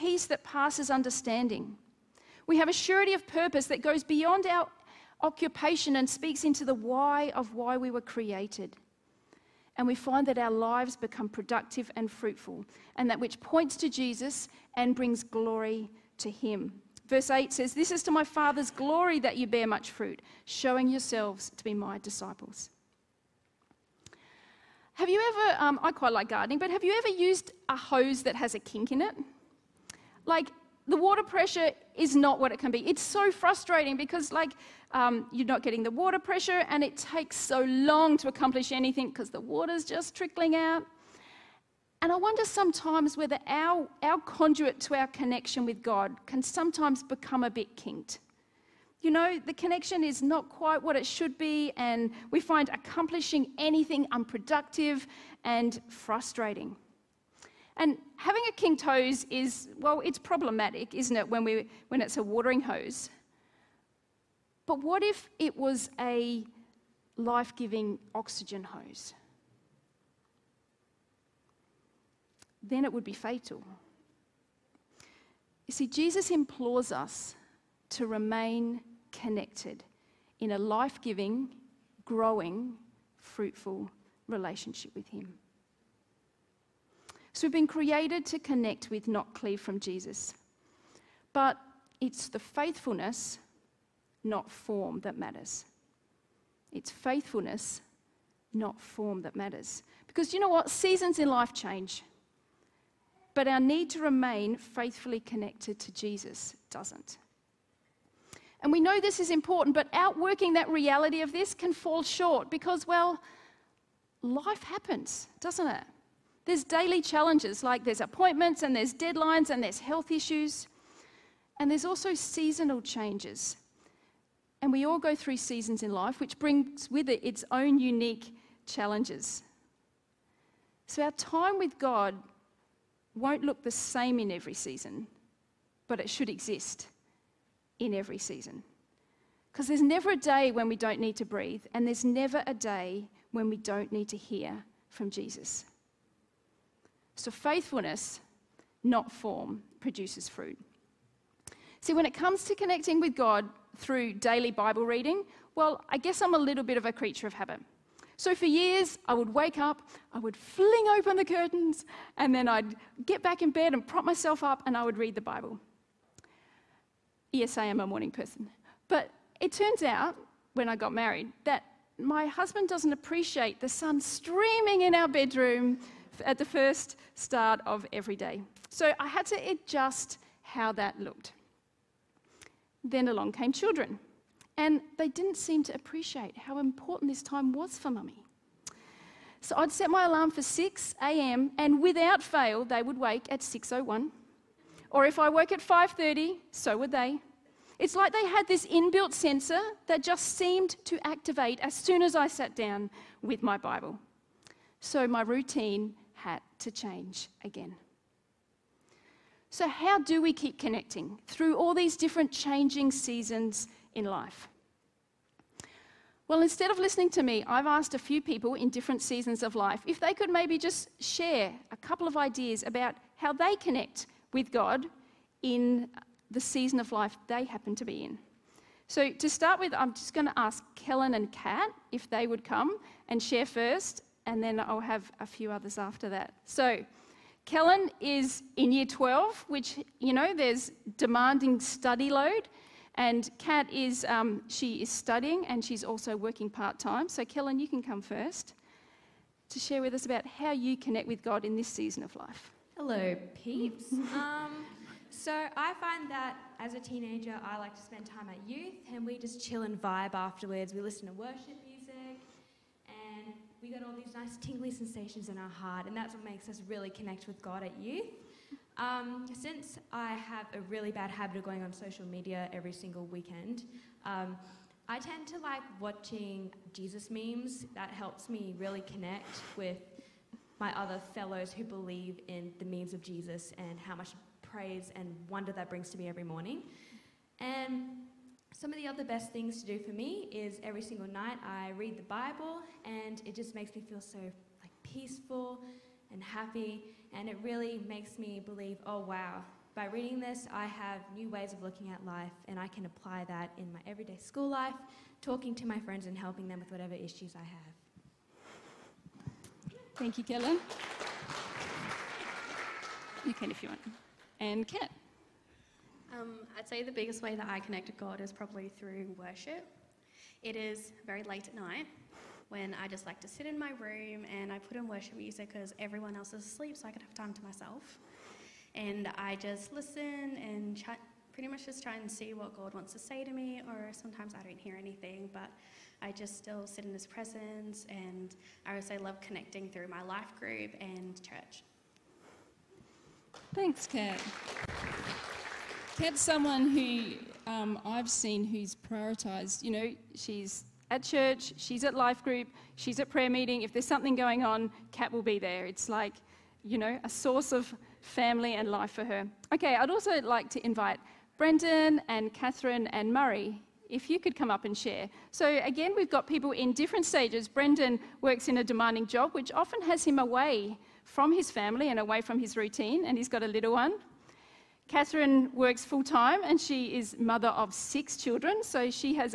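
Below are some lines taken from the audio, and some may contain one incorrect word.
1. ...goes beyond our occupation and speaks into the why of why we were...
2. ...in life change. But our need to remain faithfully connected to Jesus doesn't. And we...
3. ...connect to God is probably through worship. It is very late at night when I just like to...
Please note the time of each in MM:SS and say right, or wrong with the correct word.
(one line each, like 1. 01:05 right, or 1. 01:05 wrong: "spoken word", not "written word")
1. 00:03 right
2. 01:41 right
3. 05:17 right.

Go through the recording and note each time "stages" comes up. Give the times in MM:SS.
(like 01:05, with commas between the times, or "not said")
06:07.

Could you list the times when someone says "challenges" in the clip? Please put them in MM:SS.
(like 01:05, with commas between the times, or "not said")
01:57, 02:08.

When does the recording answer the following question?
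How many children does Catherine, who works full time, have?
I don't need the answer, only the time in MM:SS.
06:17.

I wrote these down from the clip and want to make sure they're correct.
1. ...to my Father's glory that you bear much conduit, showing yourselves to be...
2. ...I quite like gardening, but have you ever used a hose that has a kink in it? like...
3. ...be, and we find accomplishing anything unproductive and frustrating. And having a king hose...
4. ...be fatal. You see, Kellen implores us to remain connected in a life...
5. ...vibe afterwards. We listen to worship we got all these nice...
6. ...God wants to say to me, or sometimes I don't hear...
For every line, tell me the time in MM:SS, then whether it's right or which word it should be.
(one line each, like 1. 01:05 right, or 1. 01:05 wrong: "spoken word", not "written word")
1. 00:18 wrong: "fruit", not "conduit"
2. 00:25 right
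3. 00:51 right
4. 01:13 wrong: "Jesus", not "Kellen"
5. 04:19 right
6. 05:32 right.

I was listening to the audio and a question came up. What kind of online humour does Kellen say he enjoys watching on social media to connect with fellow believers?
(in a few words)
Jesus memes.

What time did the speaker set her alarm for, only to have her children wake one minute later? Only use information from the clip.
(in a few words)
6 a.m.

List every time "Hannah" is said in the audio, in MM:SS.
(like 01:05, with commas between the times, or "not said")
not said.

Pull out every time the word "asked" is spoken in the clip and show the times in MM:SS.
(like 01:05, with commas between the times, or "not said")
03:37.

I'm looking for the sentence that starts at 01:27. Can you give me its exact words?
So we've been created to connect with, not cleave from Jesus.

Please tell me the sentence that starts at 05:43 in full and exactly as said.
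Thanks, Kat had someone who um, I've seen who's prioritised.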